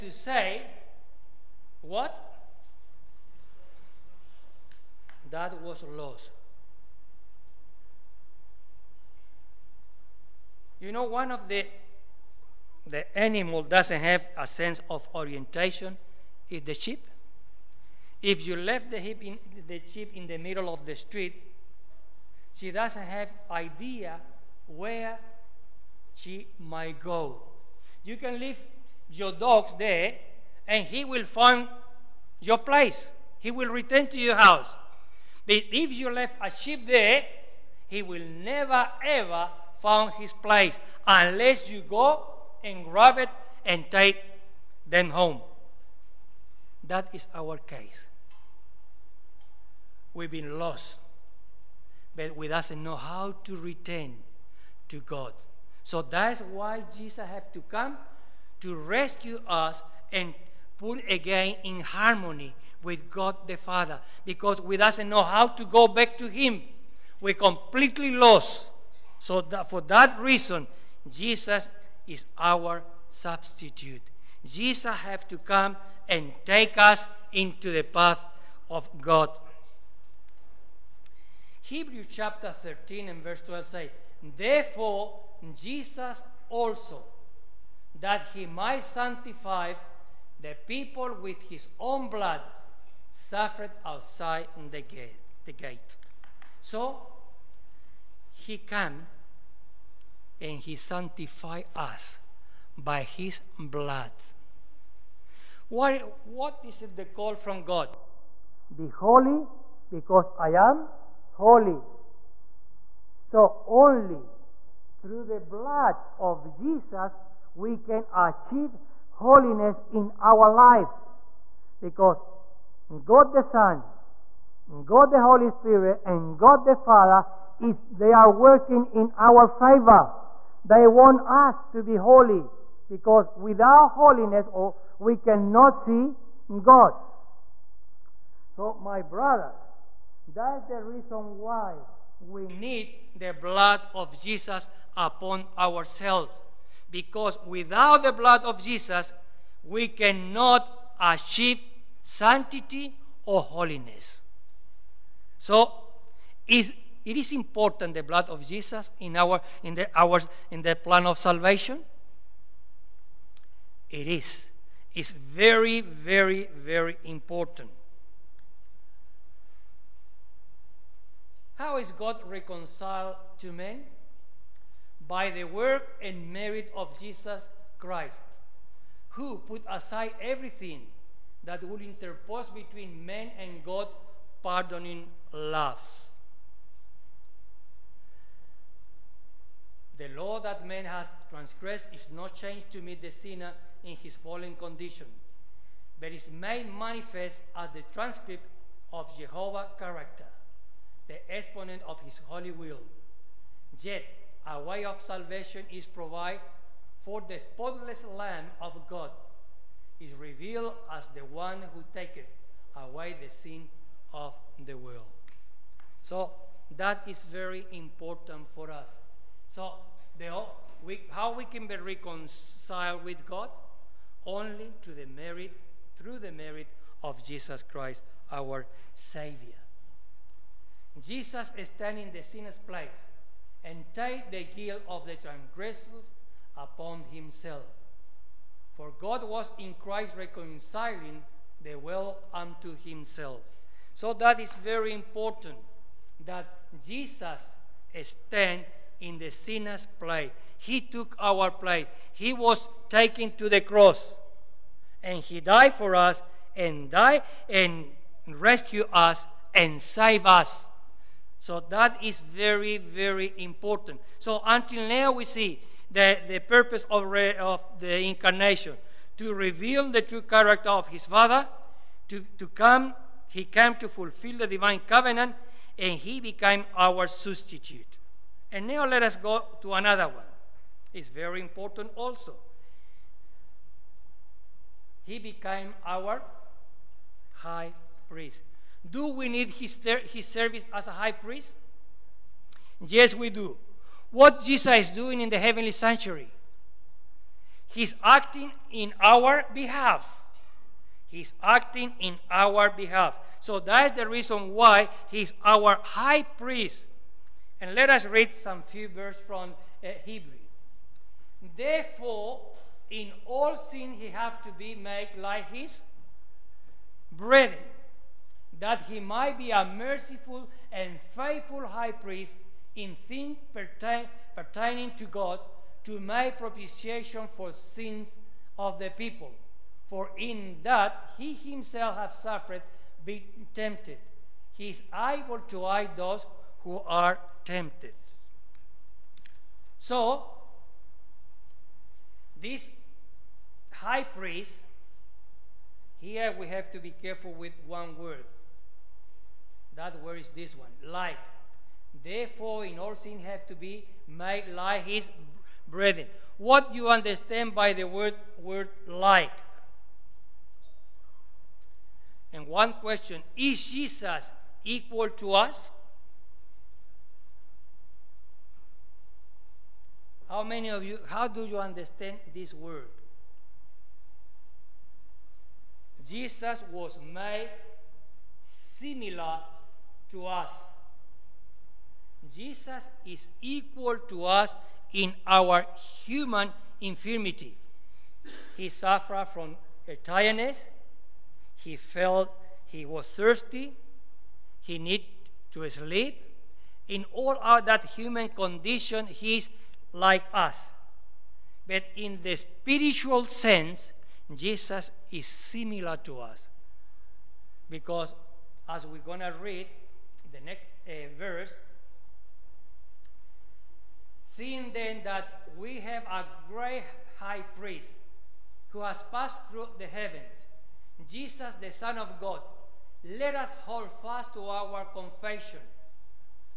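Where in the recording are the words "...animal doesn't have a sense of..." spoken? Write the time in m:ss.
0:13.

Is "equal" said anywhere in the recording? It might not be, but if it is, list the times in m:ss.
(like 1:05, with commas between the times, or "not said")
6:04, 6:23.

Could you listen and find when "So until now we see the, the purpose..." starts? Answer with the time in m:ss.
4:24.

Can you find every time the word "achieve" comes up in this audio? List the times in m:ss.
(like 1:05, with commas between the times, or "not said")
1:58, 2:30.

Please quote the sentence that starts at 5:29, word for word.
For in that he himself hath suffered being tempted.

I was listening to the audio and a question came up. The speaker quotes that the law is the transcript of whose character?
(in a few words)
Jehovah's.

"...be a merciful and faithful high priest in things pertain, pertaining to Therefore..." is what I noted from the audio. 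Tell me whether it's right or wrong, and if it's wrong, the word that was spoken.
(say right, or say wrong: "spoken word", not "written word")
wrong: "God", not "Therefore".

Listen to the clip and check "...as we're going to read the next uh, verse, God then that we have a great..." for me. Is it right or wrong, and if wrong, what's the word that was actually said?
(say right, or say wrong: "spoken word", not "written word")
wrong: "Seeing", not "God".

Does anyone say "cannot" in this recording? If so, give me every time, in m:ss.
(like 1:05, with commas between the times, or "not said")
2:15, 2:29.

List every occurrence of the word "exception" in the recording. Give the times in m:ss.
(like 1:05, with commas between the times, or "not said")
not said.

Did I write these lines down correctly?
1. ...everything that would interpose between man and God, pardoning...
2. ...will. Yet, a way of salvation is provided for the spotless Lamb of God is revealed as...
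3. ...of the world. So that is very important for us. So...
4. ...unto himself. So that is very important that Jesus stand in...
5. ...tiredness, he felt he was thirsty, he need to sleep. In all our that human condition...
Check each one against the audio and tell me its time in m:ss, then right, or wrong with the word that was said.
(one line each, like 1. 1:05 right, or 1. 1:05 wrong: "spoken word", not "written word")
1. 3:00 right
2. 3:22 right
3. 3:34 right
4. 4:02 right
5. 6:30 right.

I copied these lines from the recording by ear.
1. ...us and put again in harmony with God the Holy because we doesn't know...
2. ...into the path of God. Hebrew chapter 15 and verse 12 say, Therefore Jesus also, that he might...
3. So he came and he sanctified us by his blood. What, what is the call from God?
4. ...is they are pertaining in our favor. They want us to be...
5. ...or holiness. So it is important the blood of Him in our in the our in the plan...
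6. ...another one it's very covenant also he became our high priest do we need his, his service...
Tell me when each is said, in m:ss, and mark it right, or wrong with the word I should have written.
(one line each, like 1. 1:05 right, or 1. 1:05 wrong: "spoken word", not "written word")
1. 0:59 wrong: "Father", not "Holy"
2. 1:17 wrong: "13", not "15"
3. 1:36 right
4. 2:07 wrong: "working", not "pertaining"
5. 2:33 wrong: "Jesus", not "Him"
6. 4:39 wrong: "important", not "covenant".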